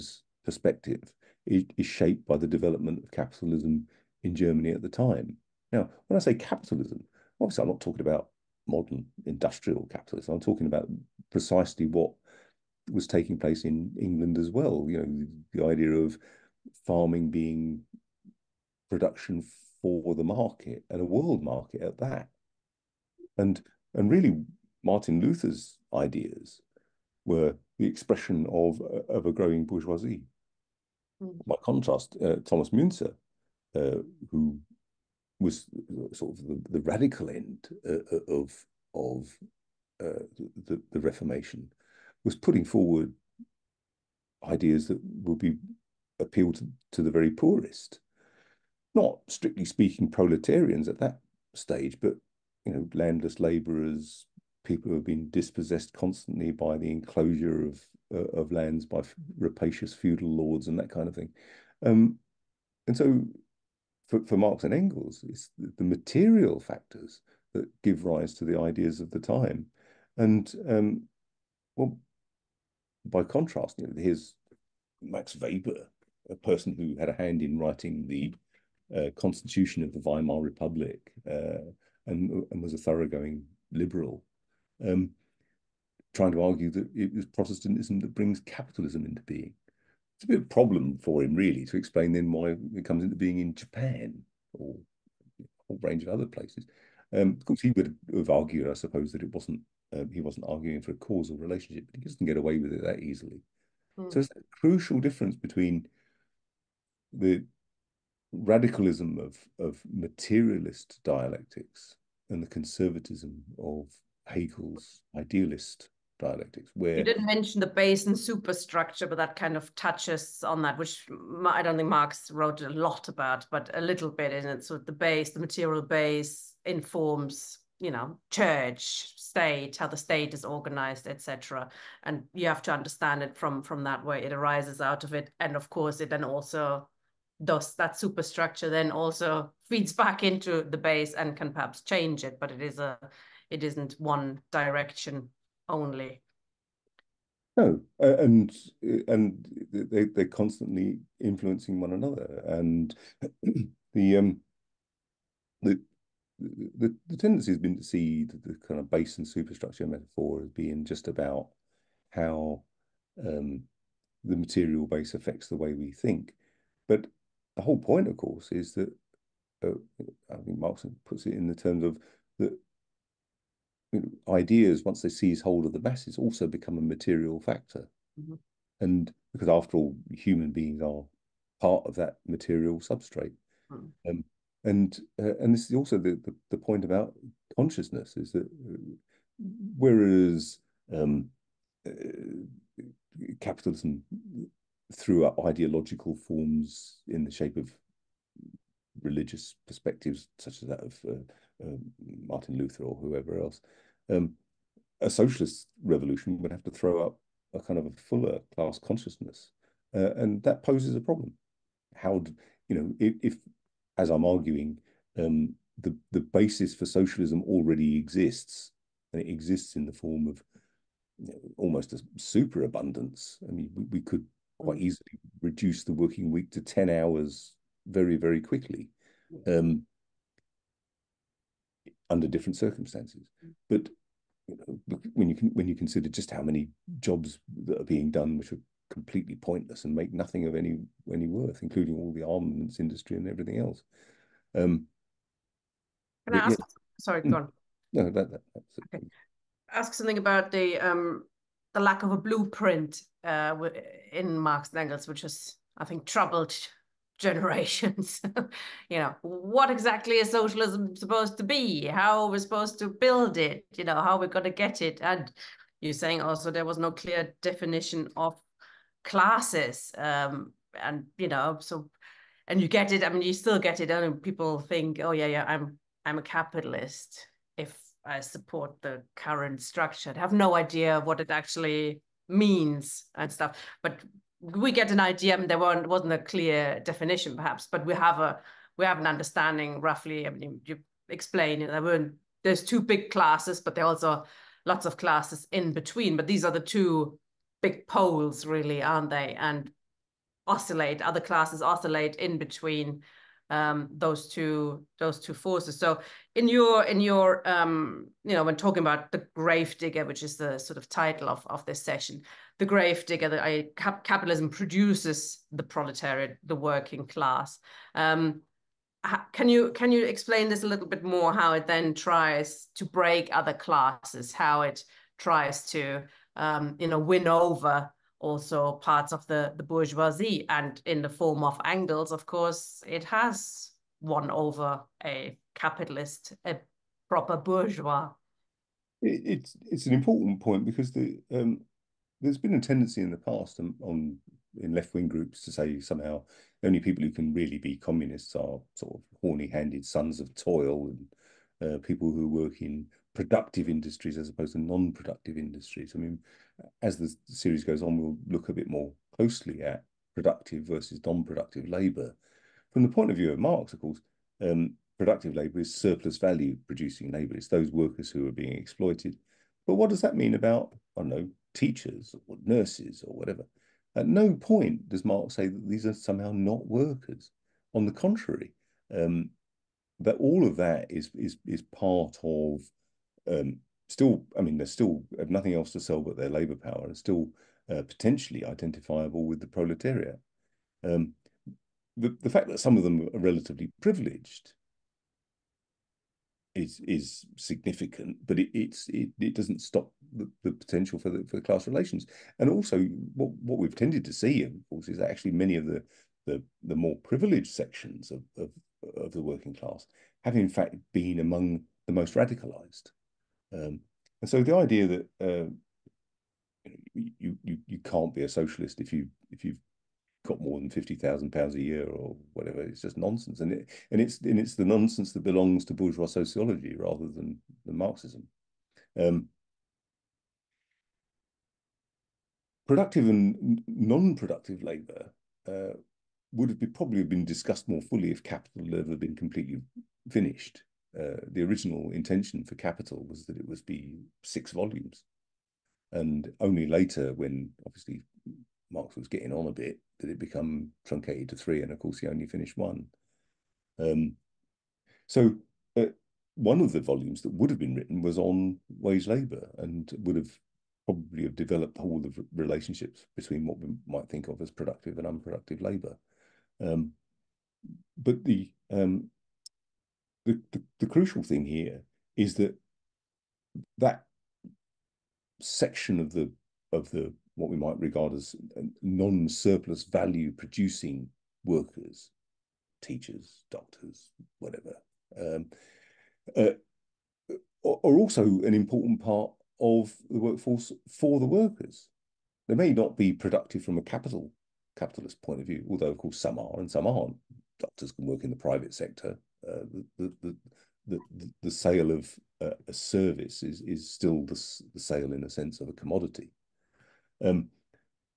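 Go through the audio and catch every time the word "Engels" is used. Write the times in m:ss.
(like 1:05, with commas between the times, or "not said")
1:04, 4:14, 5:31.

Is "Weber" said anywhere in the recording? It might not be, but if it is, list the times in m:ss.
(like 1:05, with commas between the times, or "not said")
1:15.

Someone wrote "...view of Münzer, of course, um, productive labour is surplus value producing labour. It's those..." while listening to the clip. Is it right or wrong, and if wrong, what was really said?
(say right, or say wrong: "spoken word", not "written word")
wrong: "Marx", not "Münzer".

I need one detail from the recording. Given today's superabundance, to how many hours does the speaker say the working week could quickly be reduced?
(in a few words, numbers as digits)
10.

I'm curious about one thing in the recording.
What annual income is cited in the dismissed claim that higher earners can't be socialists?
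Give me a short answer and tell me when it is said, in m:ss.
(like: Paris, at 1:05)
£50,000, at 7:00.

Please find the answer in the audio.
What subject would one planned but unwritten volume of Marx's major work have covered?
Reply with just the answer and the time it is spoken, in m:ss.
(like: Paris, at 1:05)
wage labour, at 7:38.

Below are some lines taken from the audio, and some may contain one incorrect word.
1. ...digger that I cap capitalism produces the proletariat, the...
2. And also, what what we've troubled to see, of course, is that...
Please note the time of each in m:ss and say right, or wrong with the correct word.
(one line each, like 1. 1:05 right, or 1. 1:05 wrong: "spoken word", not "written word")
1. 5:13 right
2. 6:42 wrong: "tended", not "troubled".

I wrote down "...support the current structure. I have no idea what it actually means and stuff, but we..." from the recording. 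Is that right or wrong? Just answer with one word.
right.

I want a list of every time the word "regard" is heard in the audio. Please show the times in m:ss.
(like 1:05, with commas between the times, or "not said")
7:57.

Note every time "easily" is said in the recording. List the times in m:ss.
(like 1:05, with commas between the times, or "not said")
1:43, 3:44.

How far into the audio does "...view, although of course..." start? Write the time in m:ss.
8:15.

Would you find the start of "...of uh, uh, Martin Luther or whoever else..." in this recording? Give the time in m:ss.
3:20.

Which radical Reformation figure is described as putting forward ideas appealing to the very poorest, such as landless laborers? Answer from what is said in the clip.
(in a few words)
Thomas Münzer.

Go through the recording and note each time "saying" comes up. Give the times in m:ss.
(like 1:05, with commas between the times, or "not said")
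4:25.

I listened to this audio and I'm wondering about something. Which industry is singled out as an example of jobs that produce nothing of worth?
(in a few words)
armaments industry.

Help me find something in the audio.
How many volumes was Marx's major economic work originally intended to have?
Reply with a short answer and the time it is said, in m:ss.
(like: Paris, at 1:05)
6, at 7:24.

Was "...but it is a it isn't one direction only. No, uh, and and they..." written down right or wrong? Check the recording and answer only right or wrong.
right.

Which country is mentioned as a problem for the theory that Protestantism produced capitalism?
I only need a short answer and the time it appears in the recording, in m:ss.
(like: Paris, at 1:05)
Japan, at 1:33.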